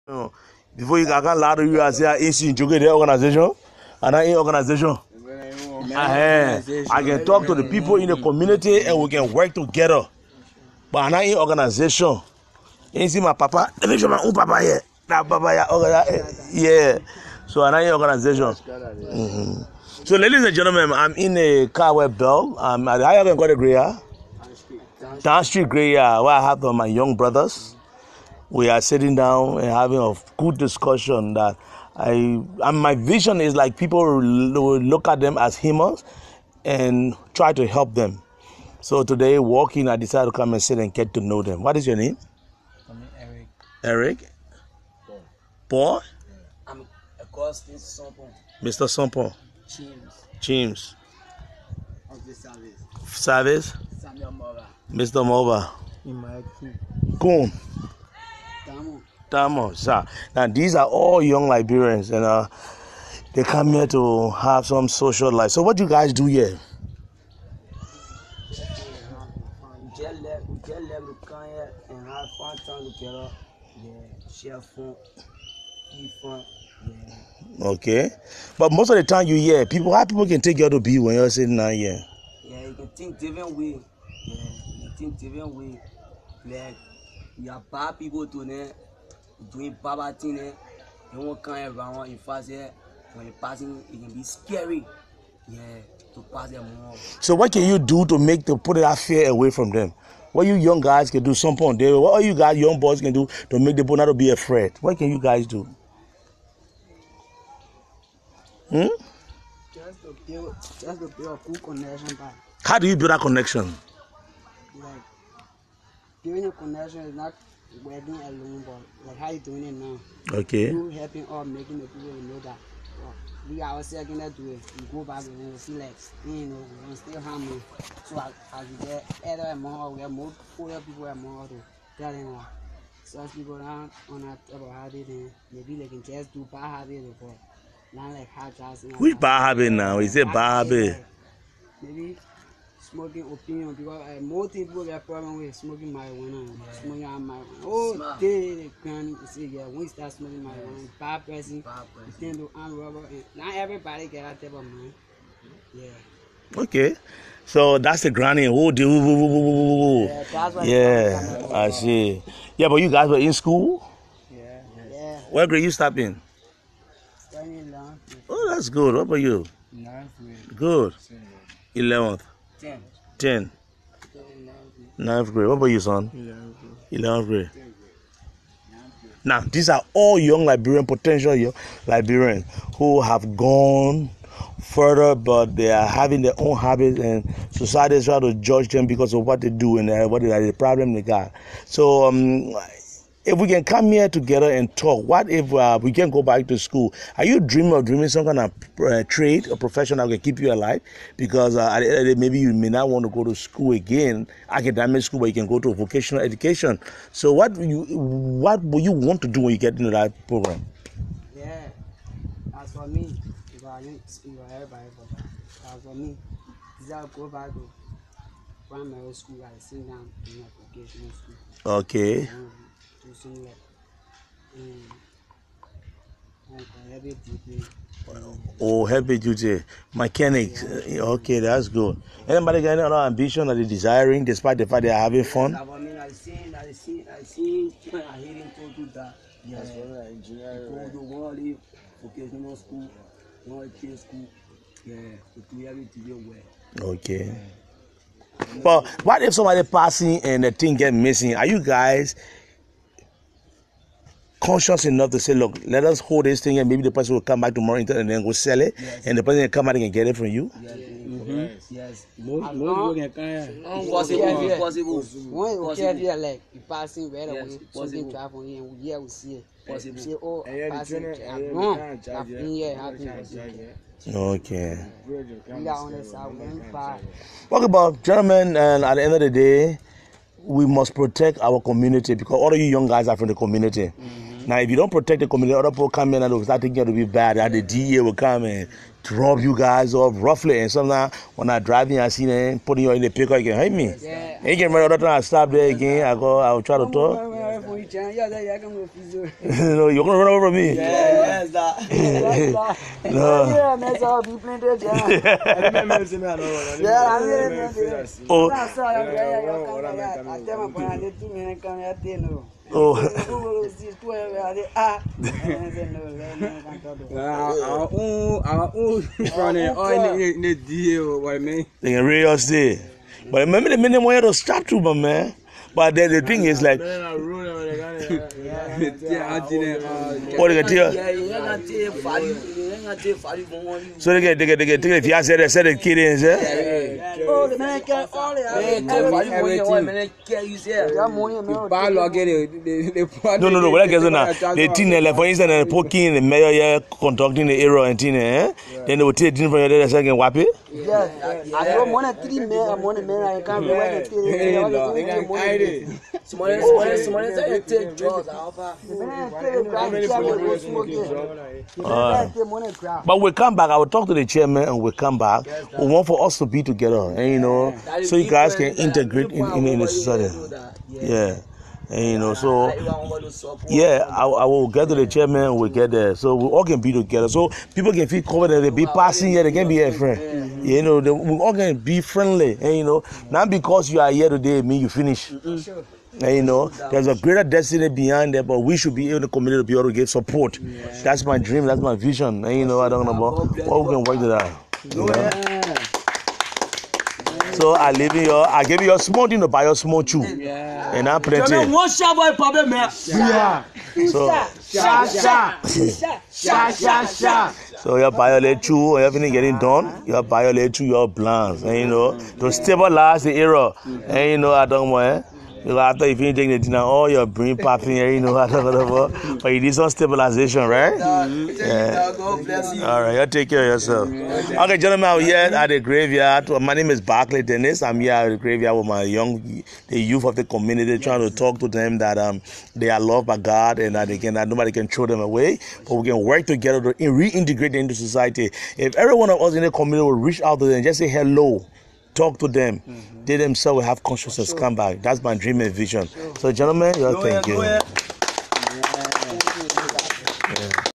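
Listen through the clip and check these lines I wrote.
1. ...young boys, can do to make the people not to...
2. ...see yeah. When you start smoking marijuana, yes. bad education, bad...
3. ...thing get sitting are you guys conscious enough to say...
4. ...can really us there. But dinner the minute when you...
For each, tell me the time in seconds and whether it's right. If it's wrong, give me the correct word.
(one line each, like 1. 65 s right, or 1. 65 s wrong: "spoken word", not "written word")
1. 102 s right
2. 149 s wrong: "person", not "education"
3. 250 s wrong: "missing", not "sitting"
4. 321 s wrong: "remember", not "dinner".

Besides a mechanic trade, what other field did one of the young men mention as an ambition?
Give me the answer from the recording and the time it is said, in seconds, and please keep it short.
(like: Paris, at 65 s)
Engineering, at 240 s.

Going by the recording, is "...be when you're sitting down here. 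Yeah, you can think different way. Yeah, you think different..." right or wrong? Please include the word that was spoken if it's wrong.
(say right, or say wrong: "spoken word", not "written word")
right.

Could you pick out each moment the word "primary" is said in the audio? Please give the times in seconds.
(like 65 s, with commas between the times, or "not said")
218 s.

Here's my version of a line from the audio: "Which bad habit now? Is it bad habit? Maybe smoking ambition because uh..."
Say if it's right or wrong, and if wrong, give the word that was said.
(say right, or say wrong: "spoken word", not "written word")
wrong: "opinion", not "ambition".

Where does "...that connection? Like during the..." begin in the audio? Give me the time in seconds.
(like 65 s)
113 s.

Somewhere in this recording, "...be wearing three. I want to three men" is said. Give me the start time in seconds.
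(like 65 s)
353 s.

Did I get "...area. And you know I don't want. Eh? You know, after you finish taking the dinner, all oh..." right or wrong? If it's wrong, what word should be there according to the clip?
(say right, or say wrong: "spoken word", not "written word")
right.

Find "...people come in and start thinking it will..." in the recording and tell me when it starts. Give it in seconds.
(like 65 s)
285 s.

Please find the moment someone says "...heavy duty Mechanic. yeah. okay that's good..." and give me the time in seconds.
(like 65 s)
228 s.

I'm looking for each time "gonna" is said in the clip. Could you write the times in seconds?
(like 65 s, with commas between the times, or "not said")
300 s.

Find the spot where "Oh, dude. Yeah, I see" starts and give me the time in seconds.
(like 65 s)
158 s.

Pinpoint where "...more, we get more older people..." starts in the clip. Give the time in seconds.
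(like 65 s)
129 s.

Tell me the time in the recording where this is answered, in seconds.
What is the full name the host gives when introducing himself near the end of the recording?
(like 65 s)
426 s.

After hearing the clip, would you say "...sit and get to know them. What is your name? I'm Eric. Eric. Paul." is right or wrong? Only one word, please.
right.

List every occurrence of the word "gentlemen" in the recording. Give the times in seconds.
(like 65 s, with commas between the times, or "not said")
20 s, 278 s, 424 s, 446 s.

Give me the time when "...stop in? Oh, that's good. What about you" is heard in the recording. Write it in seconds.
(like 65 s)
165 s.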